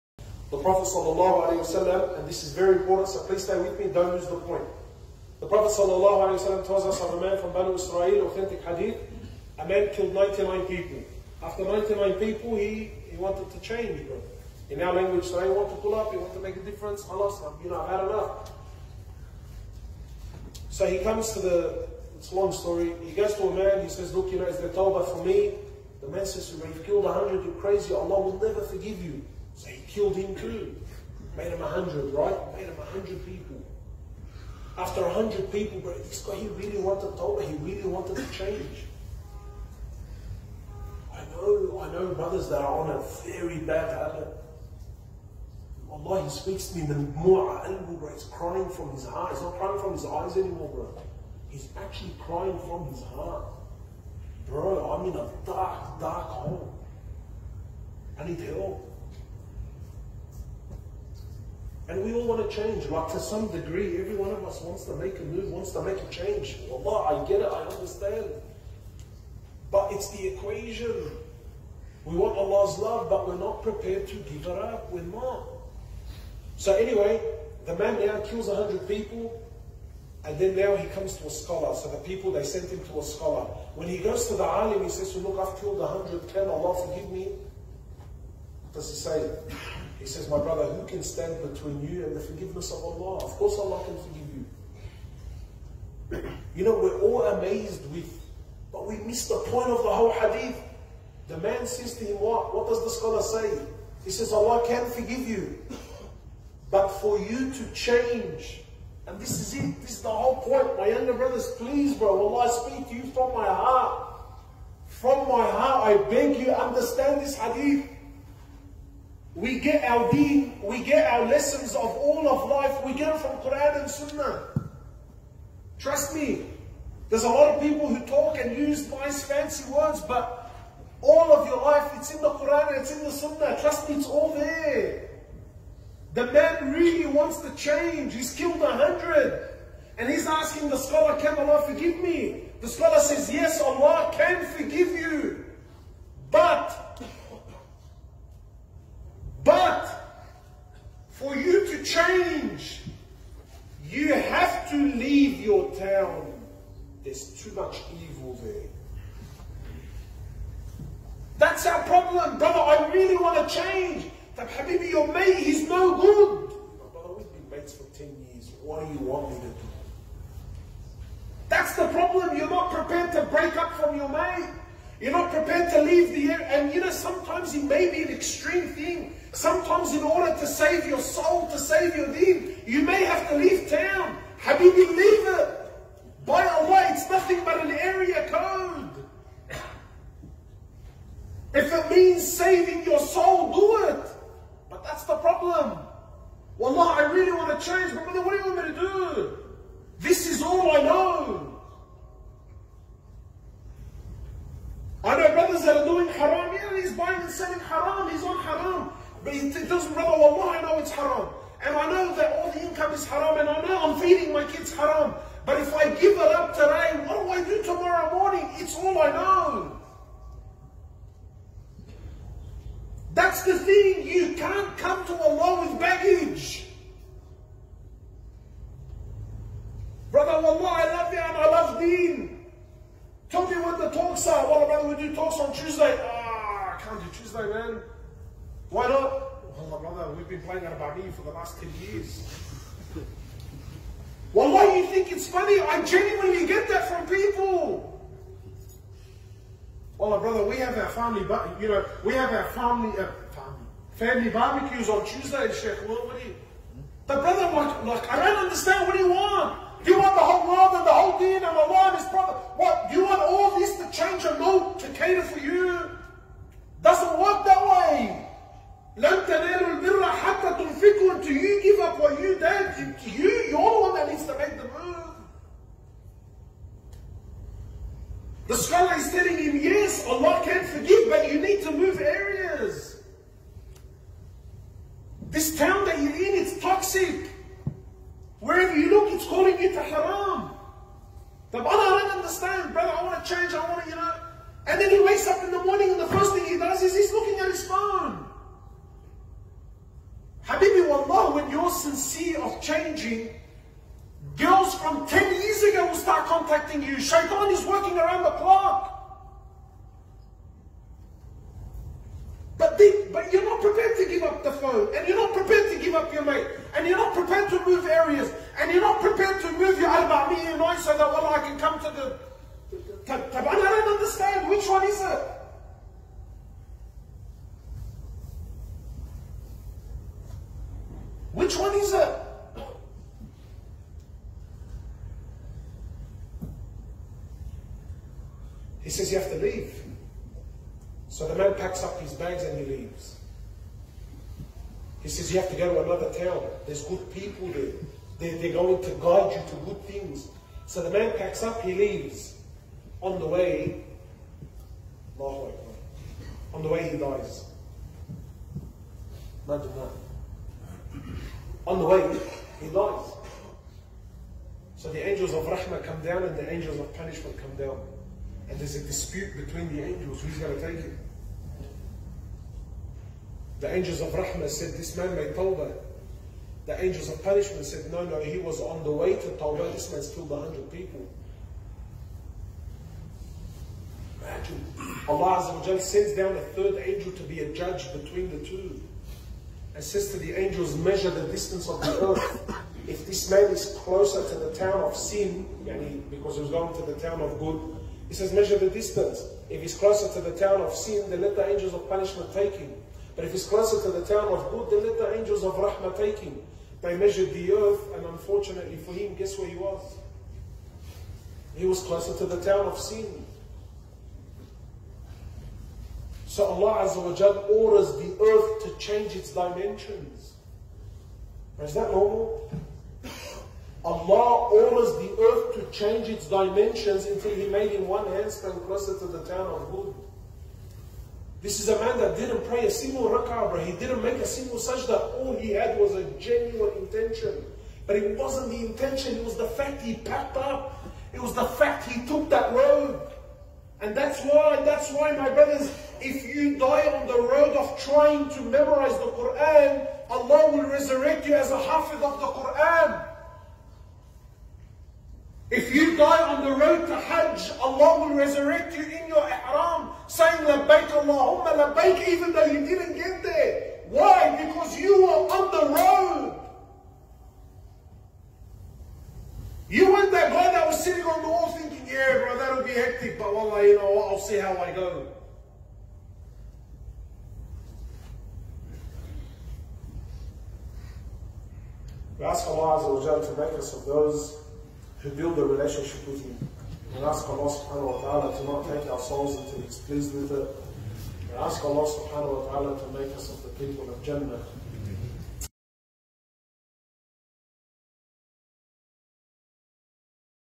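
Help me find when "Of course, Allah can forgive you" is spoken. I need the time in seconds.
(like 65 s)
93 s.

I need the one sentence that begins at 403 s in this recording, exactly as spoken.
But if it's closer to the town of good, then let the angels of Rahmah take him.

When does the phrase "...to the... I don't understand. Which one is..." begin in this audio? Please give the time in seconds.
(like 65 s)
321 s.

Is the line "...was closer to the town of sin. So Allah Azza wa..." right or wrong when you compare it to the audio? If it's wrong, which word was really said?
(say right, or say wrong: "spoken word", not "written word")
right.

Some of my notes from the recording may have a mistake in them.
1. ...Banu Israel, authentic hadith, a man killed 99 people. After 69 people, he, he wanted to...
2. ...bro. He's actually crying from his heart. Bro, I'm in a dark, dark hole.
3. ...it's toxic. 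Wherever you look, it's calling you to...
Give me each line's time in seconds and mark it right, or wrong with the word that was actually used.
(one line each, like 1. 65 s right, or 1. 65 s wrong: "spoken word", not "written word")
1. 7 s wrong: "99", not "69"
2. 50 s right
3. 286 s right.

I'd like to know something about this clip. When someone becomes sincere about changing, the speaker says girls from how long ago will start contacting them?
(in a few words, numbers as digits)
10 years.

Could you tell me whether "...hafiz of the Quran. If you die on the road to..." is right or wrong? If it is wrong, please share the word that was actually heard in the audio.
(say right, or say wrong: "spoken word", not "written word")
right.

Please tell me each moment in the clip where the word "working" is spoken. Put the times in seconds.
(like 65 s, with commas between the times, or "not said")
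307 s.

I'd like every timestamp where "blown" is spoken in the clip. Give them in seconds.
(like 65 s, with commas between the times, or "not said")
not said.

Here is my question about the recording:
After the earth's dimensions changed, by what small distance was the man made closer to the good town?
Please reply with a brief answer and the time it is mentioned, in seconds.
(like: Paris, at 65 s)
One hand span, at 427 s.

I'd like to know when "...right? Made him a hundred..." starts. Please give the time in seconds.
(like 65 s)
32 s.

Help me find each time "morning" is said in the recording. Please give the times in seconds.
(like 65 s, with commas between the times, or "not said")
218 s, 295 s.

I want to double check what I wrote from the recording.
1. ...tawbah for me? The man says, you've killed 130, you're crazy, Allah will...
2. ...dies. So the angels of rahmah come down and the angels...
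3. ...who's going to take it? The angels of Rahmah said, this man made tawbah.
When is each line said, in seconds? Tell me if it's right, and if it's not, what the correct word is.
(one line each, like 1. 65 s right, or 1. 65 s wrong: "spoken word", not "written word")
1. 24 s wrong: "100", not "130"
2. 362 s right
3. 370 s right.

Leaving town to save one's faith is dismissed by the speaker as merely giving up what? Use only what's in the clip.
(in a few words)
An area code.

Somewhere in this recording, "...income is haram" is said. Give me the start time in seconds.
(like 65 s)
212 s.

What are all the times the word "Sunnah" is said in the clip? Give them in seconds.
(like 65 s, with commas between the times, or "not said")
123 s, 133 s.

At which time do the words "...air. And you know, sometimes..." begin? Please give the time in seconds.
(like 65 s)
176 s.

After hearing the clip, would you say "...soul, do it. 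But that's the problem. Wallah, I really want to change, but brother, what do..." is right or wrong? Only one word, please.
right.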